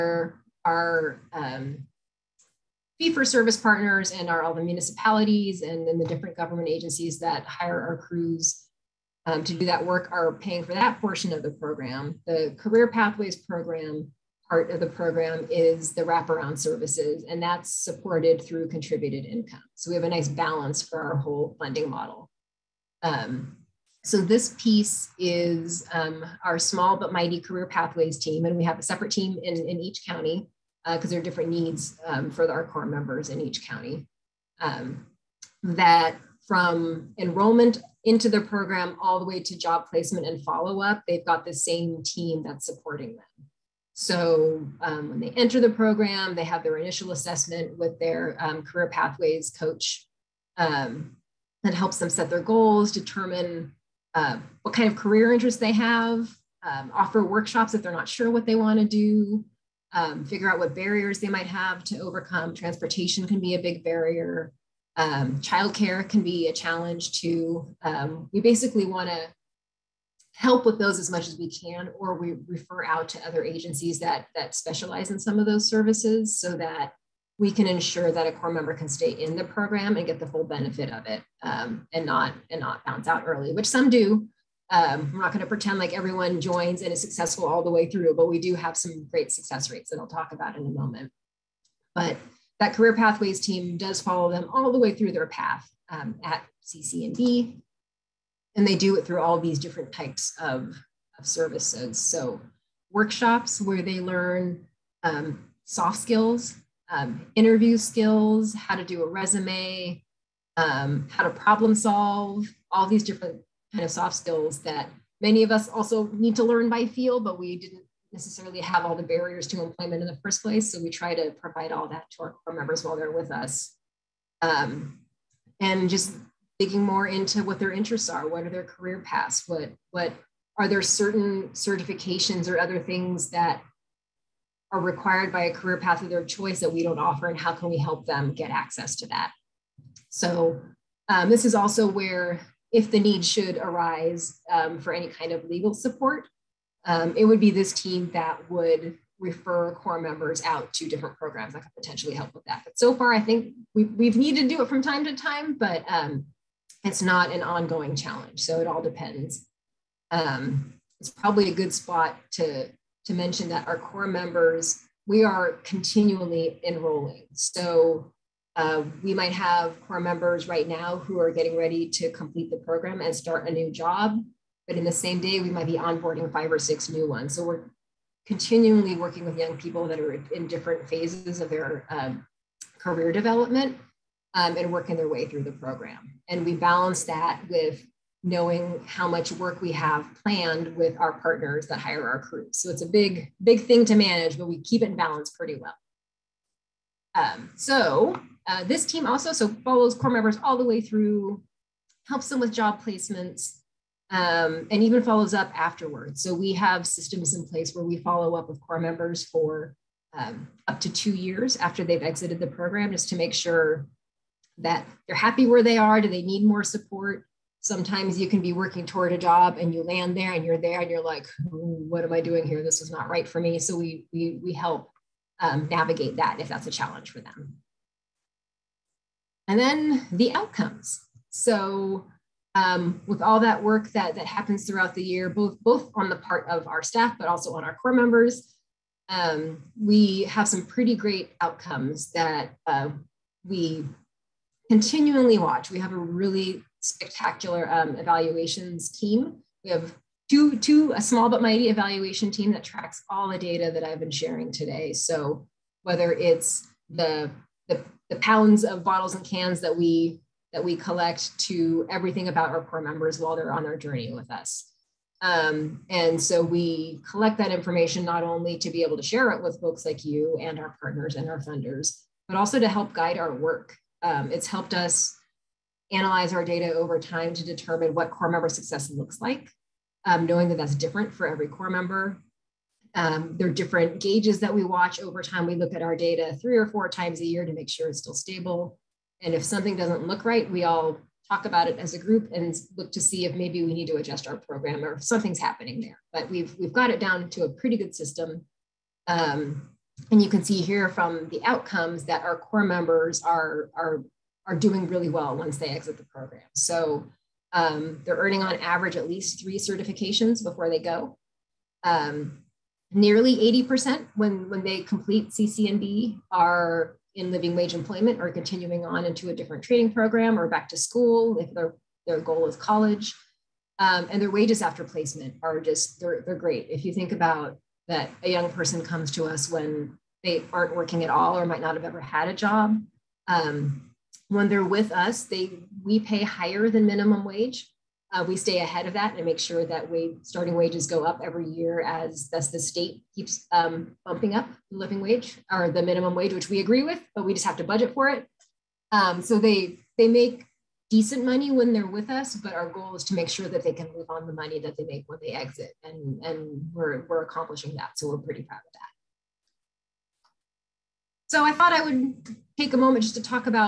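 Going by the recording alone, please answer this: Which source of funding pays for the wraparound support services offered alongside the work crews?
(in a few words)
Contributed income.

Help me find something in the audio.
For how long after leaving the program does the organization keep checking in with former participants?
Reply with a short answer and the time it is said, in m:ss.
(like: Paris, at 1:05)
2 years, at 3:30.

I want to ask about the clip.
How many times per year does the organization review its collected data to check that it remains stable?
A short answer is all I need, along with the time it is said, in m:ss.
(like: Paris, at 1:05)
3 or 4, at 4:46.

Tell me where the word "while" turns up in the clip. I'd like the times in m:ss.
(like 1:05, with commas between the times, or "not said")
2:02, 4:23.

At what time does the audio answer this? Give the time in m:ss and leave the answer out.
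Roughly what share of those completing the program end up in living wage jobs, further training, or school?
5:12.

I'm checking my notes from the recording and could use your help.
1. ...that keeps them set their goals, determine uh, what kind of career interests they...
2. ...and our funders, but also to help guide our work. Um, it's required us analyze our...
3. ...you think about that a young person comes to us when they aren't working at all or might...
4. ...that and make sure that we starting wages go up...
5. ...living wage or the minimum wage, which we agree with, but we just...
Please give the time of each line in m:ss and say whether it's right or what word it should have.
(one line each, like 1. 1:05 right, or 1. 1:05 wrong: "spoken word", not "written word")
1. 0:51 wrong: "helps", not "keeps"
2. 4:31 wrong: "helped", not "required"
3. 5:26 right
4. 5:38 right
5. 5:44 right.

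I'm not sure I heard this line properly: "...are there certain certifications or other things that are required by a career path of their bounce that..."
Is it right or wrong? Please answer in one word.
wrong.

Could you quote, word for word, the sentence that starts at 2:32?
But so far, I think we, we've needed to do it from time to time, but um, it's not an ongoing challenge.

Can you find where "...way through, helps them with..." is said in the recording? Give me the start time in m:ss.
3:20.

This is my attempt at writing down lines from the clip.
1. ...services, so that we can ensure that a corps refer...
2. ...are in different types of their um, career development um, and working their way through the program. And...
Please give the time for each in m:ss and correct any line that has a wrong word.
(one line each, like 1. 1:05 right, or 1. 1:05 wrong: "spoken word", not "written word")
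1. 1:15 wrong: "member", not "refer"
2. 2:59 wrong: "phases", not "types".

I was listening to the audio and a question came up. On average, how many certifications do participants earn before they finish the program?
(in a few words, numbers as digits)
3.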